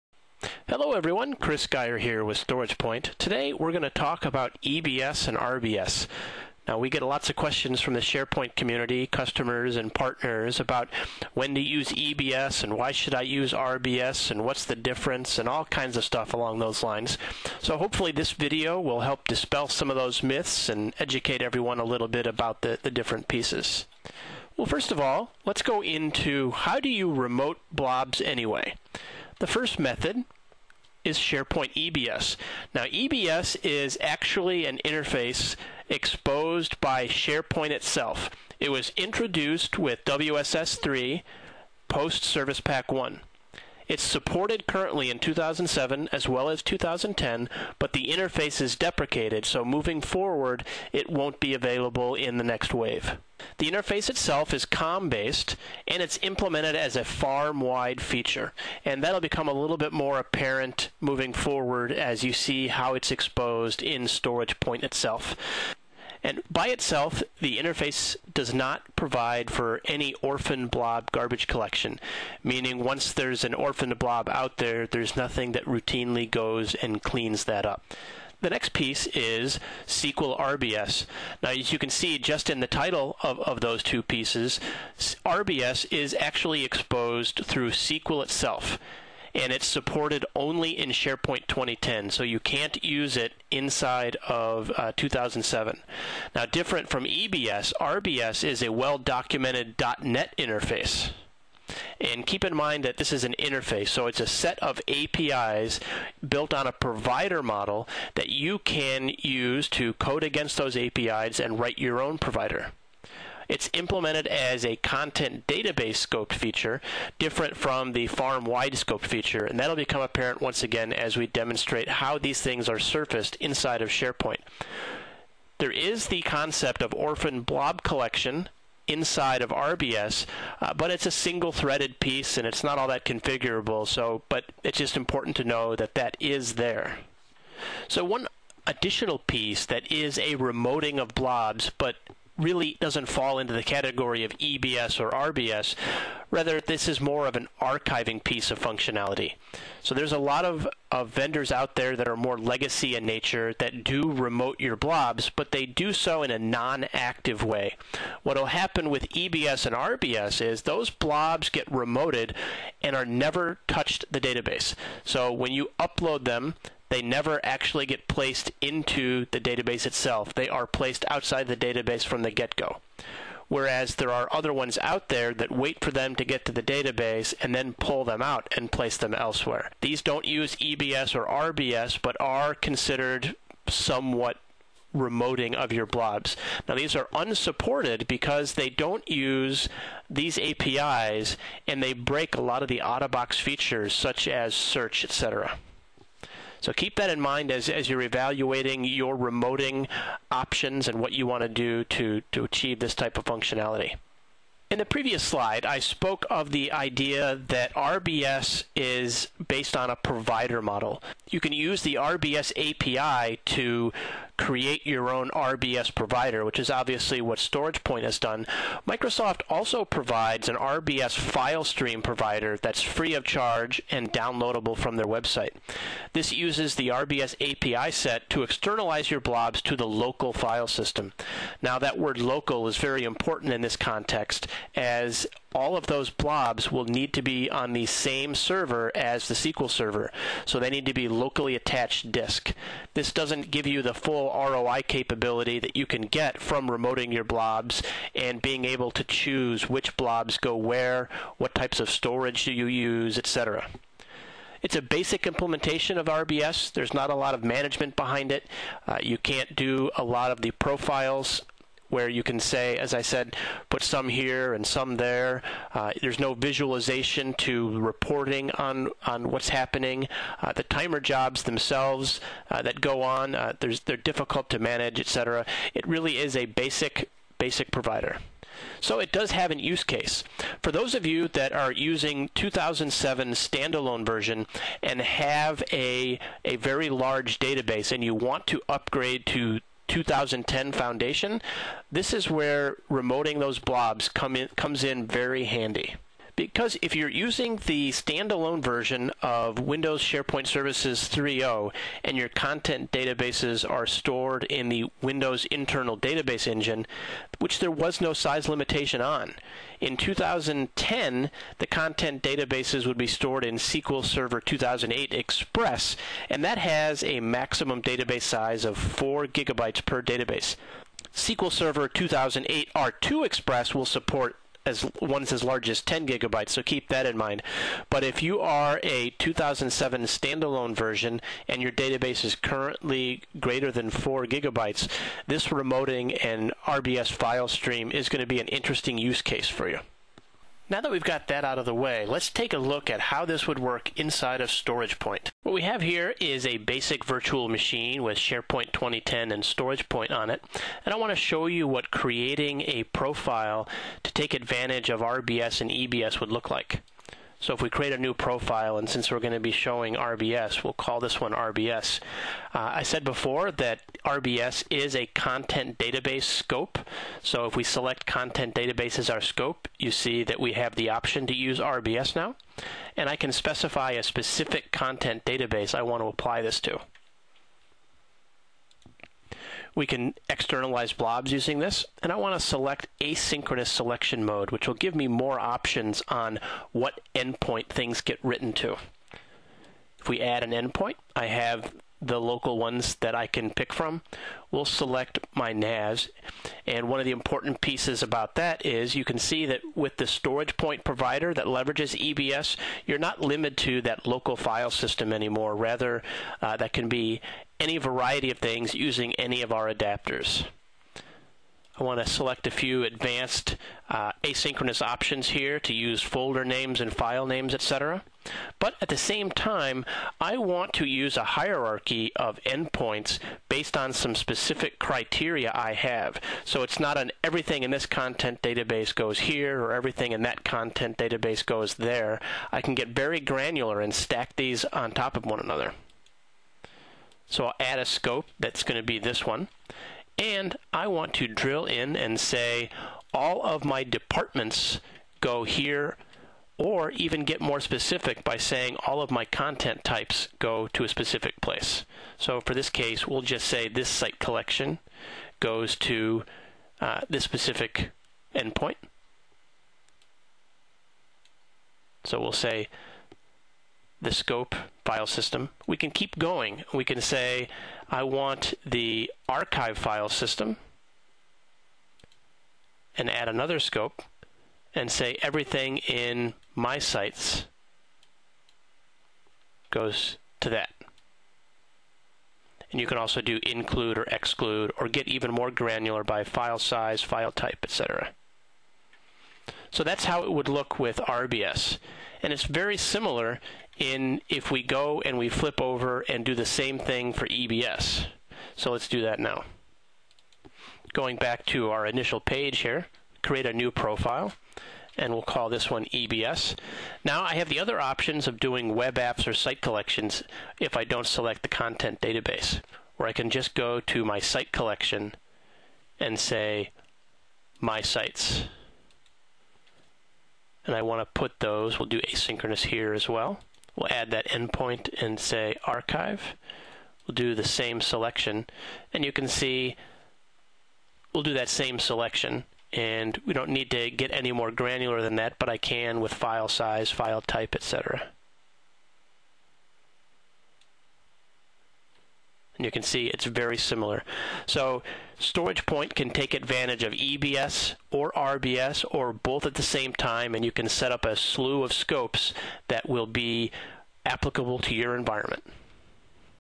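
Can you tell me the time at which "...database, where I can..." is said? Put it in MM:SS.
08:32.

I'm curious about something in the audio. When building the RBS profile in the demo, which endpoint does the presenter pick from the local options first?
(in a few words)
NAS.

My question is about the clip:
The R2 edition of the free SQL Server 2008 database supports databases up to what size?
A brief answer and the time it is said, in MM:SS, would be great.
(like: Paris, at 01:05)
10 gigabytes, at 05:25.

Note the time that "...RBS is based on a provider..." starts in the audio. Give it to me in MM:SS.
03:27.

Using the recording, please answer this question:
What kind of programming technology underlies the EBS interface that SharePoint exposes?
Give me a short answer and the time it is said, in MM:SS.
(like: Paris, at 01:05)
COM based, at 00:54.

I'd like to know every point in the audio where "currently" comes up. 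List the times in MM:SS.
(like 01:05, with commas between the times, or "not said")
00:44, 05:32.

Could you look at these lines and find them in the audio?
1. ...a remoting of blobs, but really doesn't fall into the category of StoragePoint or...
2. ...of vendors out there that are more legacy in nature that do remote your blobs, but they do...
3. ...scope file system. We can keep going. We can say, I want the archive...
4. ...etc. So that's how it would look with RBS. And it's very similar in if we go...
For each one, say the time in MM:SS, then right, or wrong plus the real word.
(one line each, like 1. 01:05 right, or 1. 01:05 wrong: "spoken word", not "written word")
1. 02:20 wrong: "EBS", not "StoragePoint"
2. 02:30 right
3. 07:44 right
4. 08:07 right.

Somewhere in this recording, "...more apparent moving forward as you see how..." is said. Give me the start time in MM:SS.
00:59.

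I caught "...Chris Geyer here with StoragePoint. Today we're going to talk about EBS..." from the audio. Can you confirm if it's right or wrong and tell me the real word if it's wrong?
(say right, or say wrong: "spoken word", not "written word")
right.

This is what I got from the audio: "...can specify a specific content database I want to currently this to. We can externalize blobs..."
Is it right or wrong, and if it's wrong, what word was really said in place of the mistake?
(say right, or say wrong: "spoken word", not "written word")
wrong: "apply", not "currently".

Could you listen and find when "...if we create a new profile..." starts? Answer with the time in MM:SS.
05:57.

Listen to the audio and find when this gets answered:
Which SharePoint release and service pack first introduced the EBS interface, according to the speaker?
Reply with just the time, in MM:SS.
00:40.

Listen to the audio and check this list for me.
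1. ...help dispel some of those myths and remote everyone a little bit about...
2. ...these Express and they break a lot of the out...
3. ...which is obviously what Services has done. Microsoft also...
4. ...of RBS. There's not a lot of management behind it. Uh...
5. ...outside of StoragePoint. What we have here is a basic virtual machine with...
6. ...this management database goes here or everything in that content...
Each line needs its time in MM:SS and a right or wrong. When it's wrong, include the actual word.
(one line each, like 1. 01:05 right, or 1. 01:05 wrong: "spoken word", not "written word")
1. 00:19 wrong: "educate", not "remote"
2. 03:10 wrong: "APIs", not "Express"
3. 03:36 wrong: "StoragePoint", not "Services"
4. 04:15 right
5. 05:43 wrong: "inside", not "outside"
6. 07:07 wrong: "content", not "management".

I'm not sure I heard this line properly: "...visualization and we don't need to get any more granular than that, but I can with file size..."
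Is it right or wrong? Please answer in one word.
wrong.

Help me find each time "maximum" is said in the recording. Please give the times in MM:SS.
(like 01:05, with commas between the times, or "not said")
05:17.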